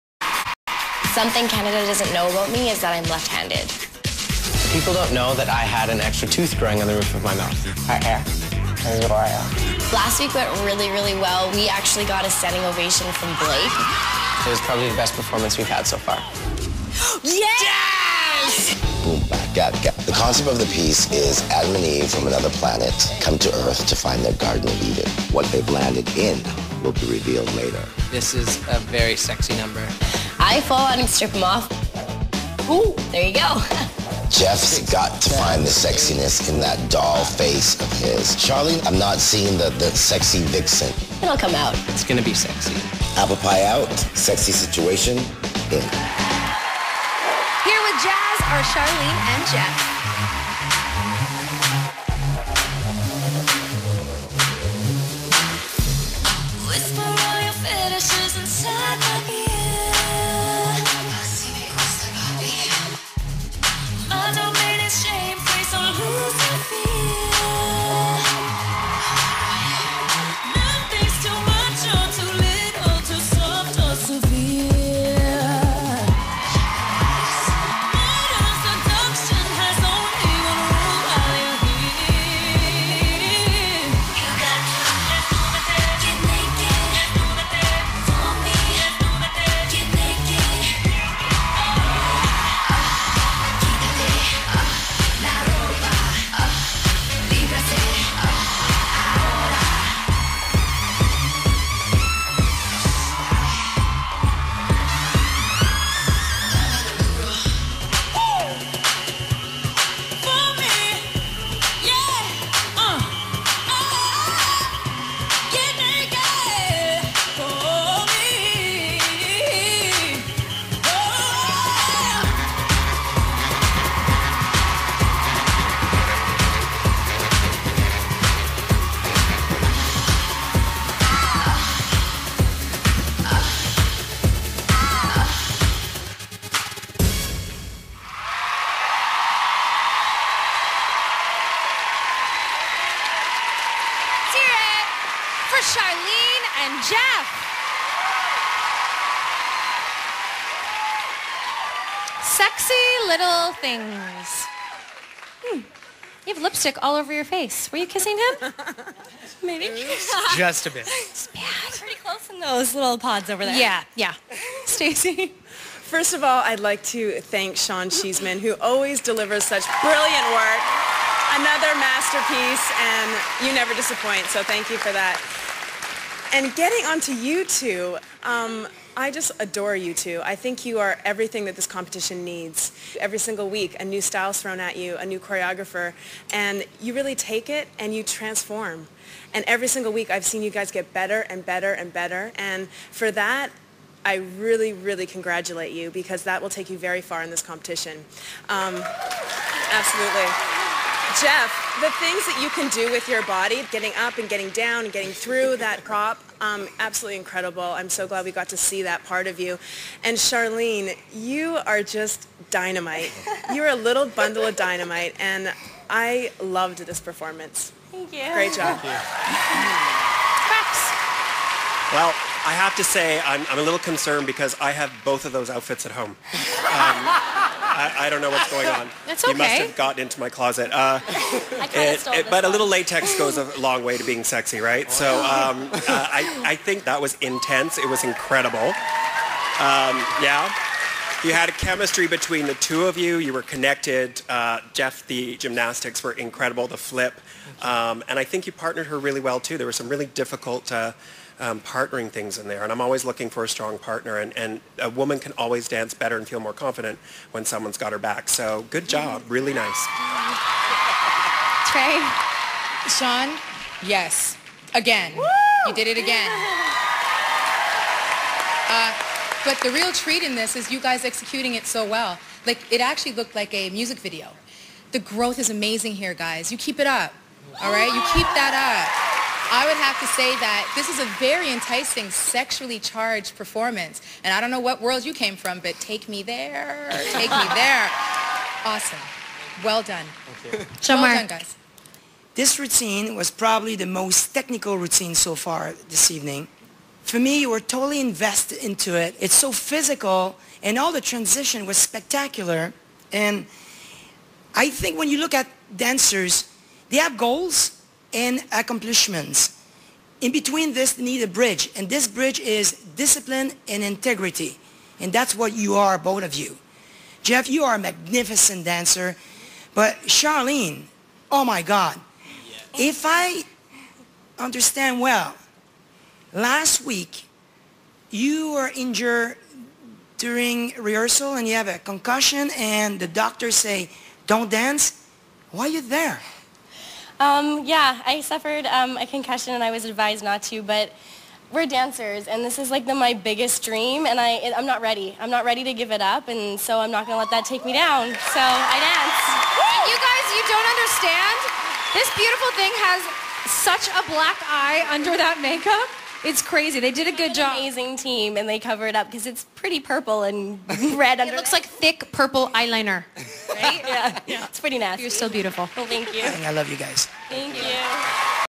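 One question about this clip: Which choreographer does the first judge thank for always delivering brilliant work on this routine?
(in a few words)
Sean Cheesman.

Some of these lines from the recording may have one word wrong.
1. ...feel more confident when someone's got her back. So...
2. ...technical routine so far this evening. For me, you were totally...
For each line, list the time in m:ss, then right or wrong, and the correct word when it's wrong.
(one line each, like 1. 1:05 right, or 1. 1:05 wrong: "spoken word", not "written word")
1. 4:16 right
2. 4:54 right.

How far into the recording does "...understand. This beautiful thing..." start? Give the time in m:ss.
5:50.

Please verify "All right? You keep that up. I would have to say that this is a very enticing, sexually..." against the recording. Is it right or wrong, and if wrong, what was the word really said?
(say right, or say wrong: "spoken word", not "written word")
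right.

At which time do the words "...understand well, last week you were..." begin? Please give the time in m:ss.
5:24.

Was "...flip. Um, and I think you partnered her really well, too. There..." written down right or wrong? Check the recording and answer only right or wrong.
right.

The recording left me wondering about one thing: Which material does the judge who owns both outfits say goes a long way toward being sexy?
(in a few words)
latex.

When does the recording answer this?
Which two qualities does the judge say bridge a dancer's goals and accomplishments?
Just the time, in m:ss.
5:12.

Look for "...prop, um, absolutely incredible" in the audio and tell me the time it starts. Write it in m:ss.
3:25.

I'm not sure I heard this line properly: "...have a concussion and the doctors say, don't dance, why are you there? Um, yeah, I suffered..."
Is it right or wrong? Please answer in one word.
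right.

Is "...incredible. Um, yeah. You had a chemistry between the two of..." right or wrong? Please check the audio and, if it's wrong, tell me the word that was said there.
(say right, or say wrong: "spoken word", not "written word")
right.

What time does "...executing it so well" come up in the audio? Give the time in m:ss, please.
4:31.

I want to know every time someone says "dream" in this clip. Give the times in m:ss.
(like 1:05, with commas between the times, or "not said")
5:43.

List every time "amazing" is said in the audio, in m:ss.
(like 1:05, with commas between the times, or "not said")
4:35, 5:57.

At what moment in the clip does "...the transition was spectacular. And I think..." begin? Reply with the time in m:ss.
5:00.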